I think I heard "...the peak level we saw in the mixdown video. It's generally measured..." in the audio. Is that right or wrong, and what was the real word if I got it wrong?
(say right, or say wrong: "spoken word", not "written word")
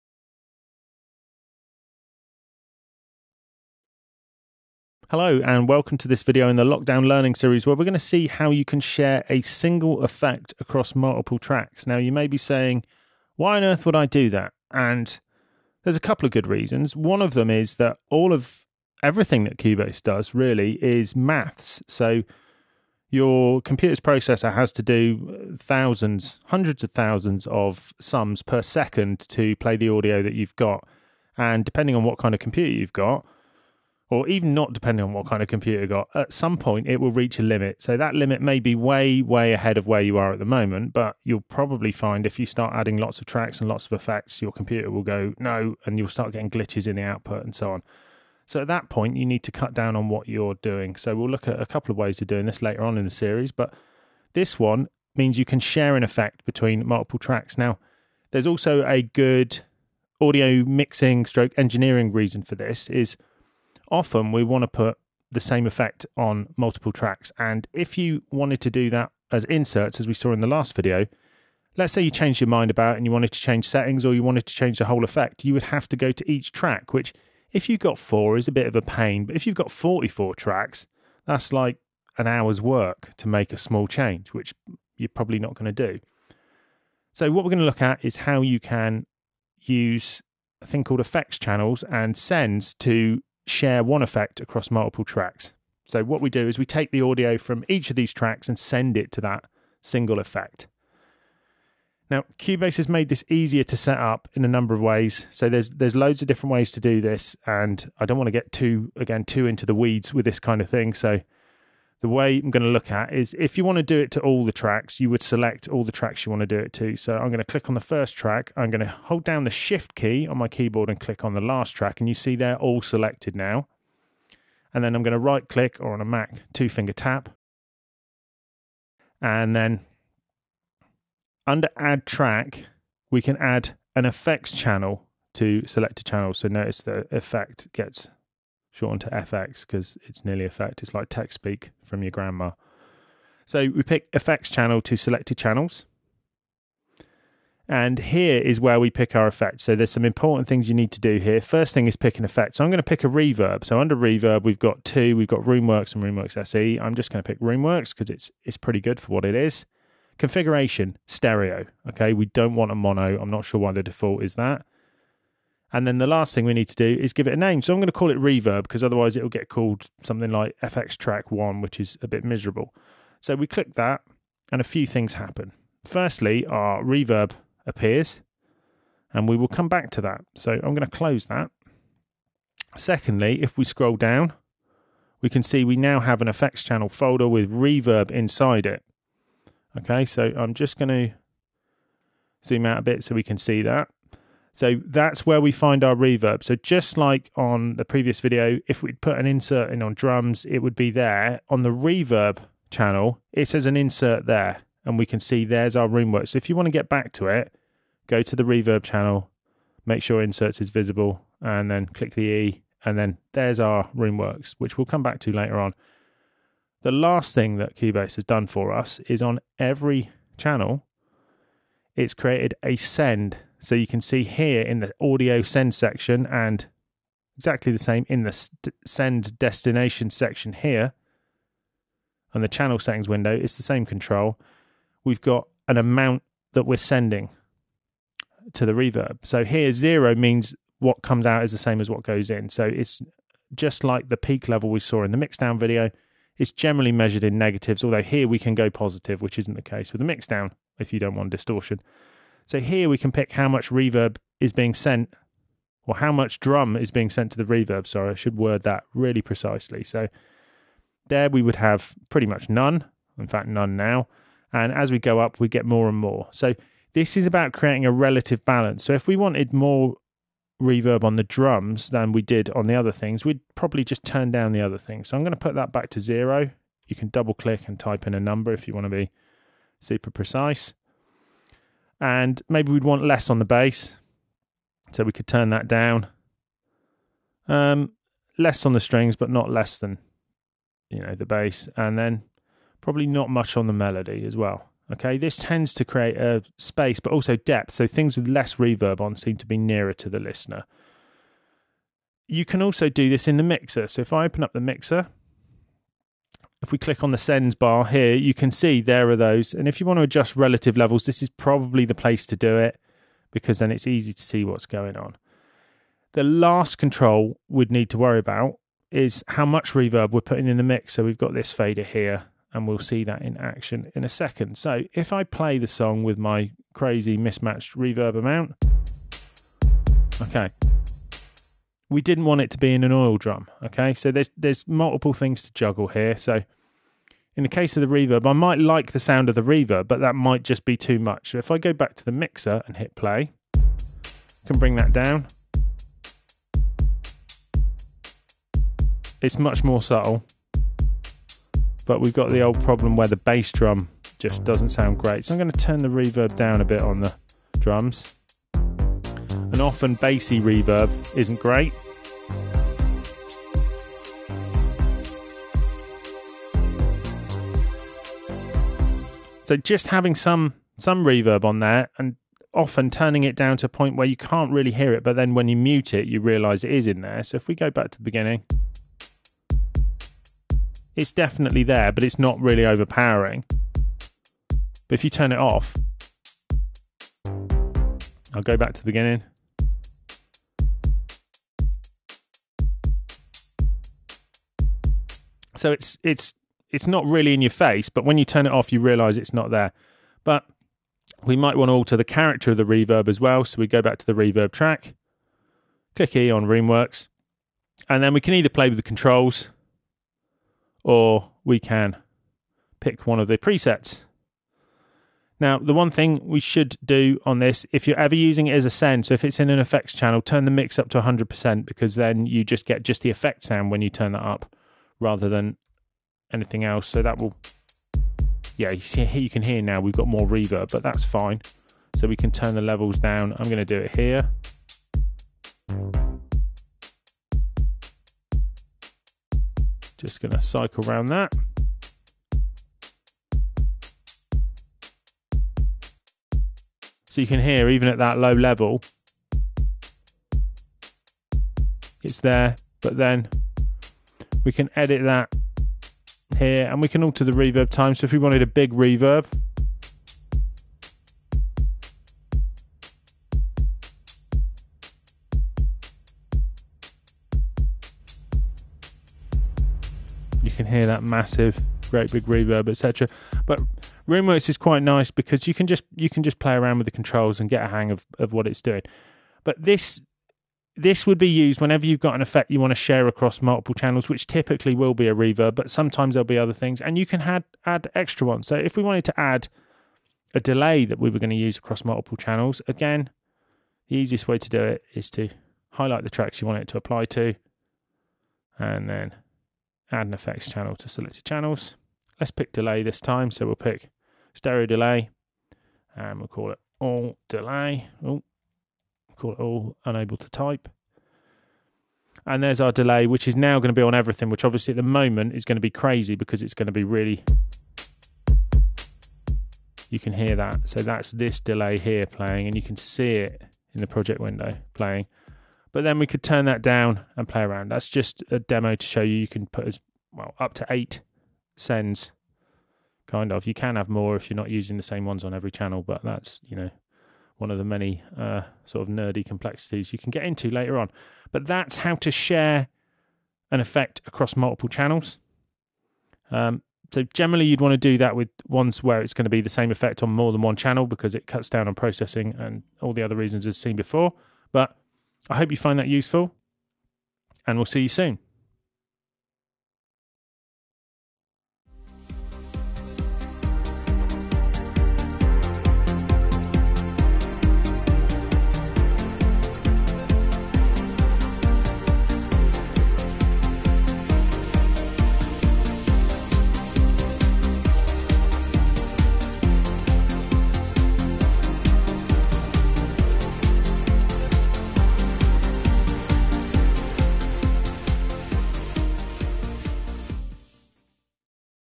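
right.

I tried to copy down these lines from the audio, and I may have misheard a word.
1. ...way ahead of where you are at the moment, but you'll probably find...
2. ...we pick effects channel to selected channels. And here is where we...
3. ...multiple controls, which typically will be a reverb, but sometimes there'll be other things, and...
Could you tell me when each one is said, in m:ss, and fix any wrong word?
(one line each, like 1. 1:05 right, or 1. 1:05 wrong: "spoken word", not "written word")
1. 0:39 right
2. 2:23 right
3. 8:03 wrong: "channels", not "controls".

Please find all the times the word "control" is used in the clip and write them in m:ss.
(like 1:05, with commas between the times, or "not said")
3:53, 5:16, 6:48, 7:56.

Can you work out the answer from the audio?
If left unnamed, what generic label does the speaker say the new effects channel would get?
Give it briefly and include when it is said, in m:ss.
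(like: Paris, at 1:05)
FX track one, at 2:50.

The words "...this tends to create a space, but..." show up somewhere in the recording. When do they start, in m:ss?
4:55.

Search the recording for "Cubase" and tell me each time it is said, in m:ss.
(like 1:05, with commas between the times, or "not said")
0:19, 1:42, 3:37.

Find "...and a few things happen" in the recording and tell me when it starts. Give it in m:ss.
2:54.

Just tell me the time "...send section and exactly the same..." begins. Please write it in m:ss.
3:45.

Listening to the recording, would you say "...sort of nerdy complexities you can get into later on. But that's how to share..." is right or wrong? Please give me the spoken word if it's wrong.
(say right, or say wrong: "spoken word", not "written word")
right.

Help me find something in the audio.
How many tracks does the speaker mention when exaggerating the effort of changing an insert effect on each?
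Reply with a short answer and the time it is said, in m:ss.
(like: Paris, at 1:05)
44, at 1:19.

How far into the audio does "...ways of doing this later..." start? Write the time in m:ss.
0:51.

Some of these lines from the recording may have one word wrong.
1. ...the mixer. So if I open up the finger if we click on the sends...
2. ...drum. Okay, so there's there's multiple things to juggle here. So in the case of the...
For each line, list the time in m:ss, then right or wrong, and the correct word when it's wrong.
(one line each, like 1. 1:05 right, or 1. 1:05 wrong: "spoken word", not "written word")
1. 5:03 wrong: "mixer", not "finger"
2. 5:33 right.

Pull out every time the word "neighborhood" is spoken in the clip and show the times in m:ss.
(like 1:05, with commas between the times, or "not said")
not said.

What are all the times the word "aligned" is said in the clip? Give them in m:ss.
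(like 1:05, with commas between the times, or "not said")
not said.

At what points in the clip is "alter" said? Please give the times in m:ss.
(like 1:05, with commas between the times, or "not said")
6:41, 7:37.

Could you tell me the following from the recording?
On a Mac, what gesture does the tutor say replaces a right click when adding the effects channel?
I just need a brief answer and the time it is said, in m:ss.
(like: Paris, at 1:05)
Two finger tap, at 2:06.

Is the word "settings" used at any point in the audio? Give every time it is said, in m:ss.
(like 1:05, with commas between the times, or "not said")
1:13, 3:52.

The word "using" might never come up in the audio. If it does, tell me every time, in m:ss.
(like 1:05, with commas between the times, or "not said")
6:58, 8:54.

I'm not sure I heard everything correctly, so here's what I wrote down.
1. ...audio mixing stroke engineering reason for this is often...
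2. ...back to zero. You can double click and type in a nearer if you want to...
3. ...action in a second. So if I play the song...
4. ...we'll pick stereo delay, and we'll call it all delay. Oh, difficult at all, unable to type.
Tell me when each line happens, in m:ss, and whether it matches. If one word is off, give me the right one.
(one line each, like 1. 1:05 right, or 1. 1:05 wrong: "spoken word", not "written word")
1. 1:00 right
2. 4:35 wrong: "number", not "nearer"
3. 5:23 right
4. 8:23 right.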